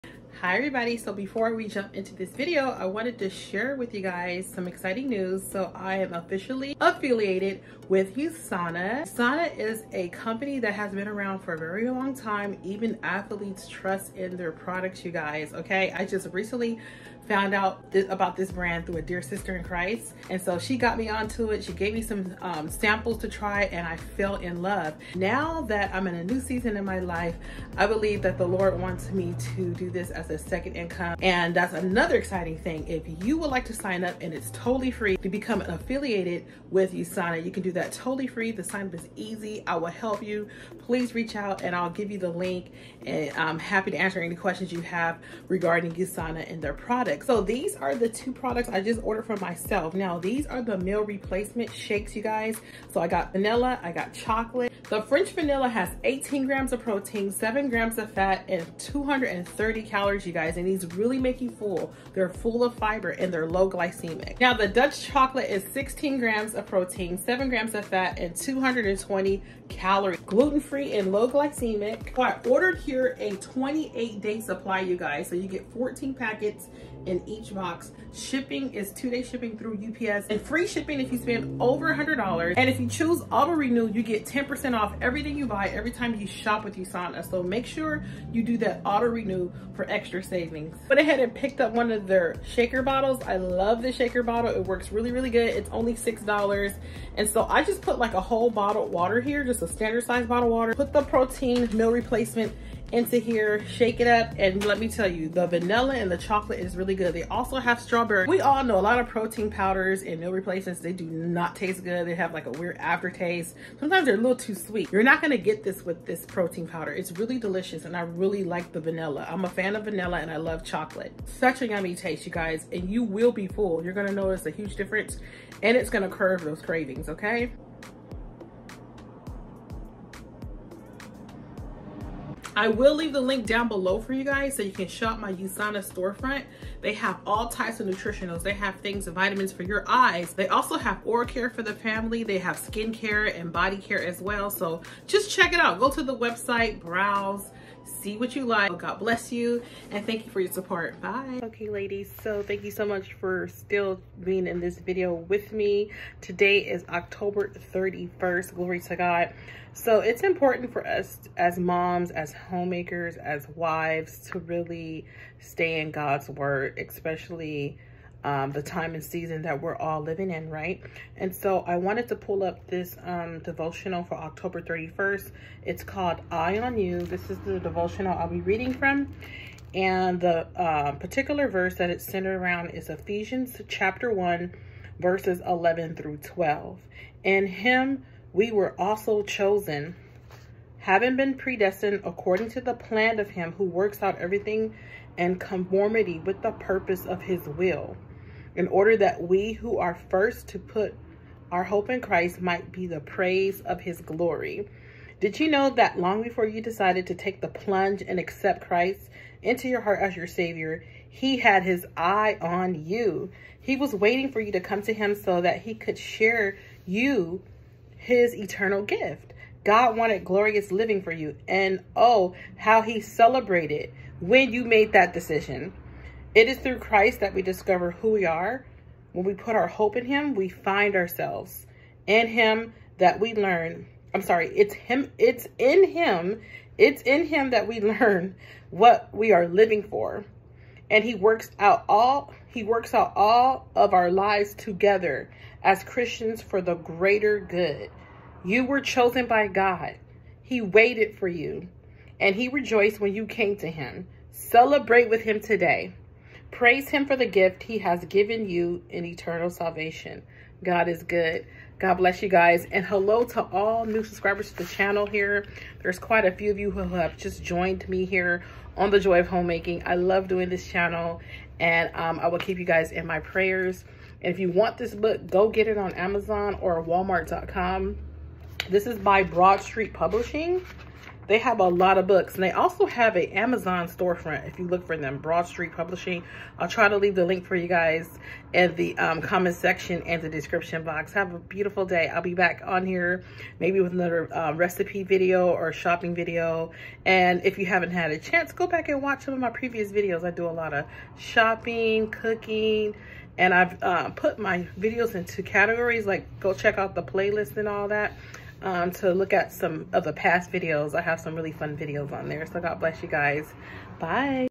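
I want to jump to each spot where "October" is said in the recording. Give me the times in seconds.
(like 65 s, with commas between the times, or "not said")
156 s, 174 s.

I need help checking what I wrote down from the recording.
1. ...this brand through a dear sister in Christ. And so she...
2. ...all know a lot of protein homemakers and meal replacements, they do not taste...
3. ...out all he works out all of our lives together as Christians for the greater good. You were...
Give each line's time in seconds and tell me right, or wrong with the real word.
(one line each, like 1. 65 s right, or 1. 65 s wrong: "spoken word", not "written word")
1. 18 s right
2. 108 s wrong: "powders", not "homemakers"
3. 241 s right.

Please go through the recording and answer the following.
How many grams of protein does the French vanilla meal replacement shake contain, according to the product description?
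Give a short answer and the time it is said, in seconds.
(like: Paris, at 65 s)
18, at 56 s.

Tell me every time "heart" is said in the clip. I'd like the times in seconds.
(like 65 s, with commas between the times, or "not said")
209 s.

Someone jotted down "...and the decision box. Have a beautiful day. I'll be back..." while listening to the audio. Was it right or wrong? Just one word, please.
wrong.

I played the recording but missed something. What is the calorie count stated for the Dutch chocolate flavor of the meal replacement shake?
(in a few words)
220.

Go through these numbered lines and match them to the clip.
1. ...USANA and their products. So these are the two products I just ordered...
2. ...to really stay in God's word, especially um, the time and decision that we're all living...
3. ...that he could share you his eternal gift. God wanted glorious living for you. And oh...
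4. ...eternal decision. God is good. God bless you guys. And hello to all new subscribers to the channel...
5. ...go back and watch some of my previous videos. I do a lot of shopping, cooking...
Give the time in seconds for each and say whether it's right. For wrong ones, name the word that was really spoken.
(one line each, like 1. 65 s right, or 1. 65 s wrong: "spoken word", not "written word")
1. 45 s right
2. 164 s wrong: "season", not "decision"
3. 215 s right
4. 259 s wrong: "salvation", not "decision"
5. 298 s right.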